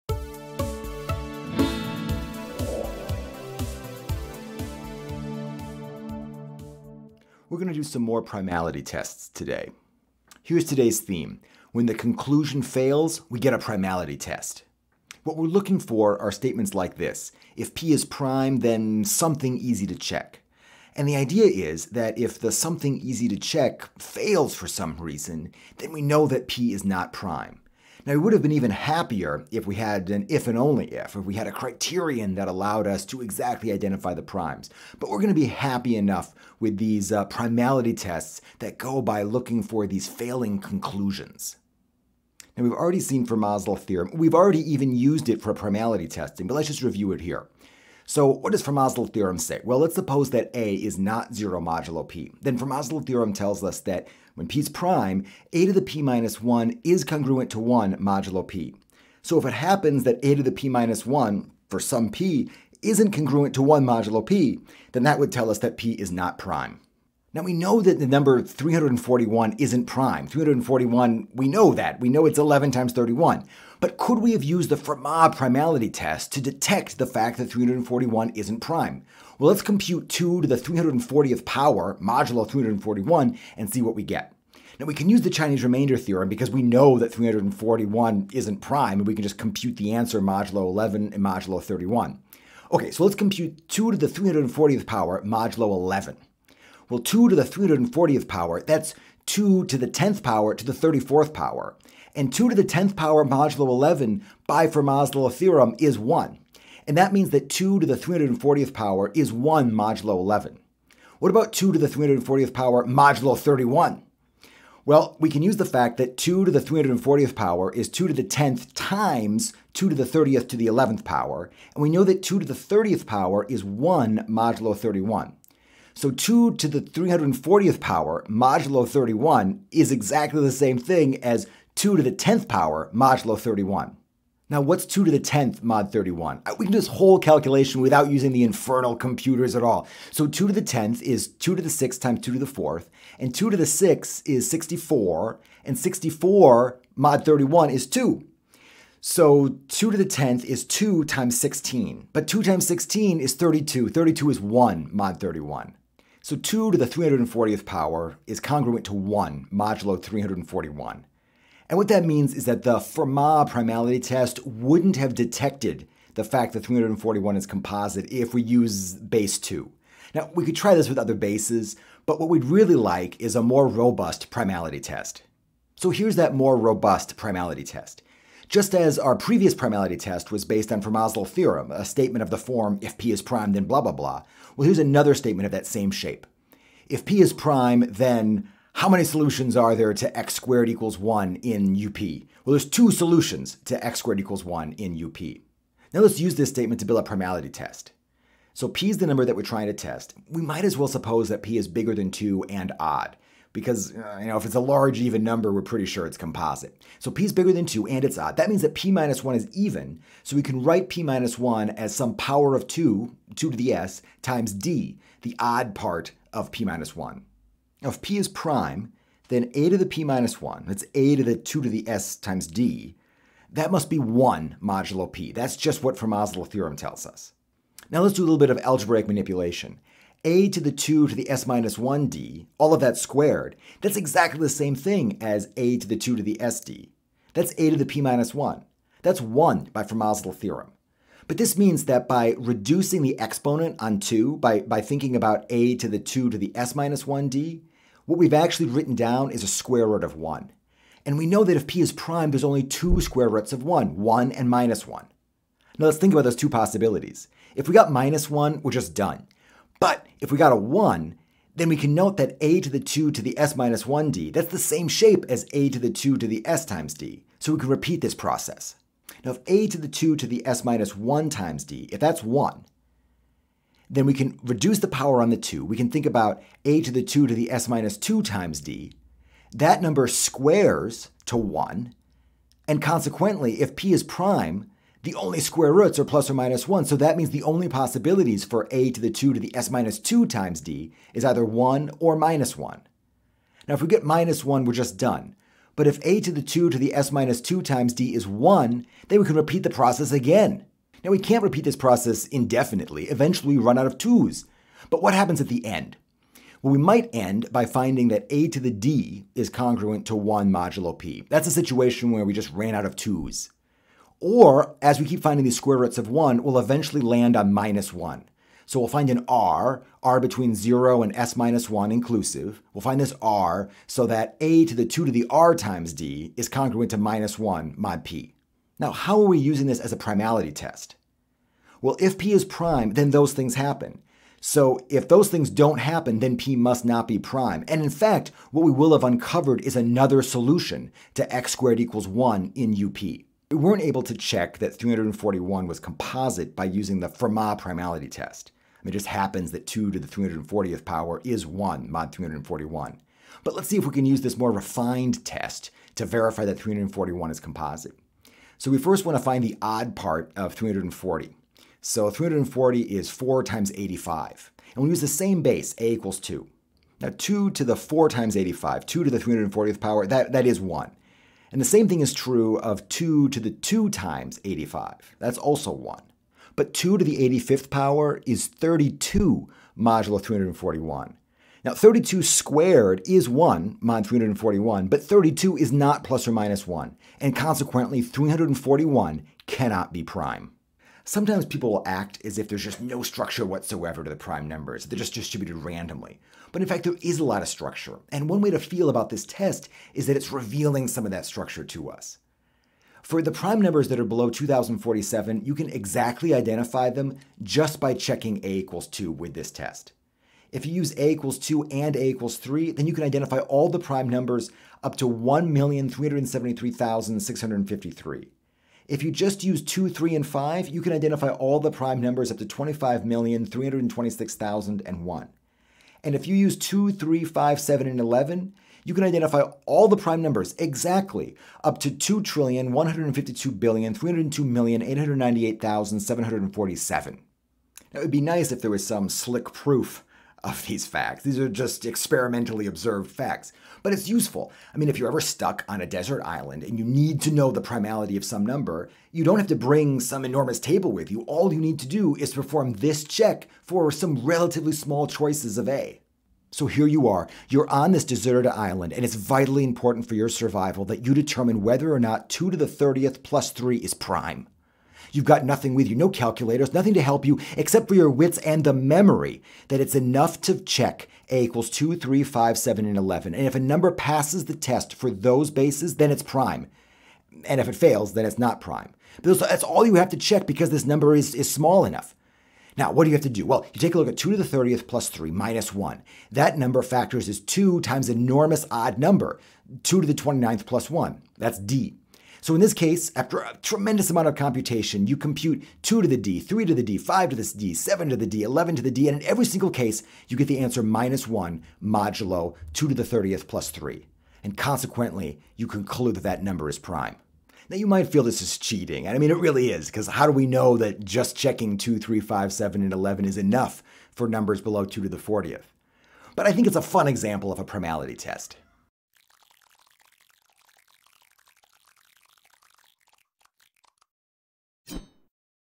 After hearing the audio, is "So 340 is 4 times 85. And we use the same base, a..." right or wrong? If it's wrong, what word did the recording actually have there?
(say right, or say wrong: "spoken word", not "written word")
right.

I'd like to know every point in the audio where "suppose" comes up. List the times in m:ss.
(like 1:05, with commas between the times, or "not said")
0:49, 3:20.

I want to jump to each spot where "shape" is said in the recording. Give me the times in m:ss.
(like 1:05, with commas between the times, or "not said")
3:05, 4:24.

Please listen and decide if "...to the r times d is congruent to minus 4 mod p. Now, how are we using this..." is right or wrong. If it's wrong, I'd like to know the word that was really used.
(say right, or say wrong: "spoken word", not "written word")
wrong: "1", not "4".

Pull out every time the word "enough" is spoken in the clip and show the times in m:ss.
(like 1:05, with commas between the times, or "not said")
0:35, 7:49, 8:01, 8:33.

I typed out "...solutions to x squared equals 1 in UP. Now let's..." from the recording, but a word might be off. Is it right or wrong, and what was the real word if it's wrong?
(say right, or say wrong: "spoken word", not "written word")
right.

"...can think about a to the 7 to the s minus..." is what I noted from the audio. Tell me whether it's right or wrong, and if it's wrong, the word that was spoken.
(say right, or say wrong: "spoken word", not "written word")
wrong: "2", not "7".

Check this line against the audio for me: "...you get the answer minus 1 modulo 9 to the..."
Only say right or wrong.
wrong.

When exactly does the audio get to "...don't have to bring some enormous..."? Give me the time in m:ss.
7:29.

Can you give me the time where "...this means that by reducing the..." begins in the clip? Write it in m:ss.
4:01.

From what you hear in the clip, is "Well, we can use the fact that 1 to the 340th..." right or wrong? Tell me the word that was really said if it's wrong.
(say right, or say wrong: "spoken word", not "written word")
wrong: "2", not "1".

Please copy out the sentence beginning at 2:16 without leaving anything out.
Uh, we can do this whole calculation without using the infernal computers at all.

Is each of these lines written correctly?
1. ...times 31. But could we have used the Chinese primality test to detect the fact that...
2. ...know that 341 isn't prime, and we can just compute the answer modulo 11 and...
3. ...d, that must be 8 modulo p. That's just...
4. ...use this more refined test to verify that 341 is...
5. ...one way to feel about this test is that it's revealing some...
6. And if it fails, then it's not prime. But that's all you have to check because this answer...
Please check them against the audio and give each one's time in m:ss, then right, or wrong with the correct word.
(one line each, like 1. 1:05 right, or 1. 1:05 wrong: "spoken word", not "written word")
1. 1:12 wrong: "Fermat", not "Chinese"
2. 1:26 right
3. 3:42 wrong: "1", not "8"
4. 5:54 right
5. 6:38 right
6. 7:57 wrong: "number", not "answer".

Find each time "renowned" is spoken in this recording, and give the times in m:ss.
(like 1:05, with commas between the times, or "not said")
not said.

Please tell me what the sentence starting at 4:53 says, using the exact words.
Now if we get minus 1, we're just done.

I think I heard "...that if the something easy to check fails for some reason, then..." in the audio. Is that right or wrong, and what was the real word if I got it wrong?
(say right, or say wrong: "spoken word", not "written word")
right.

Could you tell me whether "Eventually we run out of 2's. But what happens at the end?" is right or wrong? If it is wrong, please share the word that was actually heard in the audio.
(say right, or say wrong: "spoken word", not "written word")
right.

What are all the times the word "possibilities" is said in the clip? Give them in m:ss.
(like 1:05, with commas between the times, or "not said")
4:16, 4:47.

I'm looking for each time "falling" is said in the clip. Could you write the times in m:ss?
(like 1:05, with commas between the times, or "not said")
not said.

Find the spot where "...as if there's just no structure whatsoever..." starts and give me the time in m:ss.
6:32.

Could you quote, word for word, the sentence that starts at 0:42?
Now, we've already seen Fermat's theorem.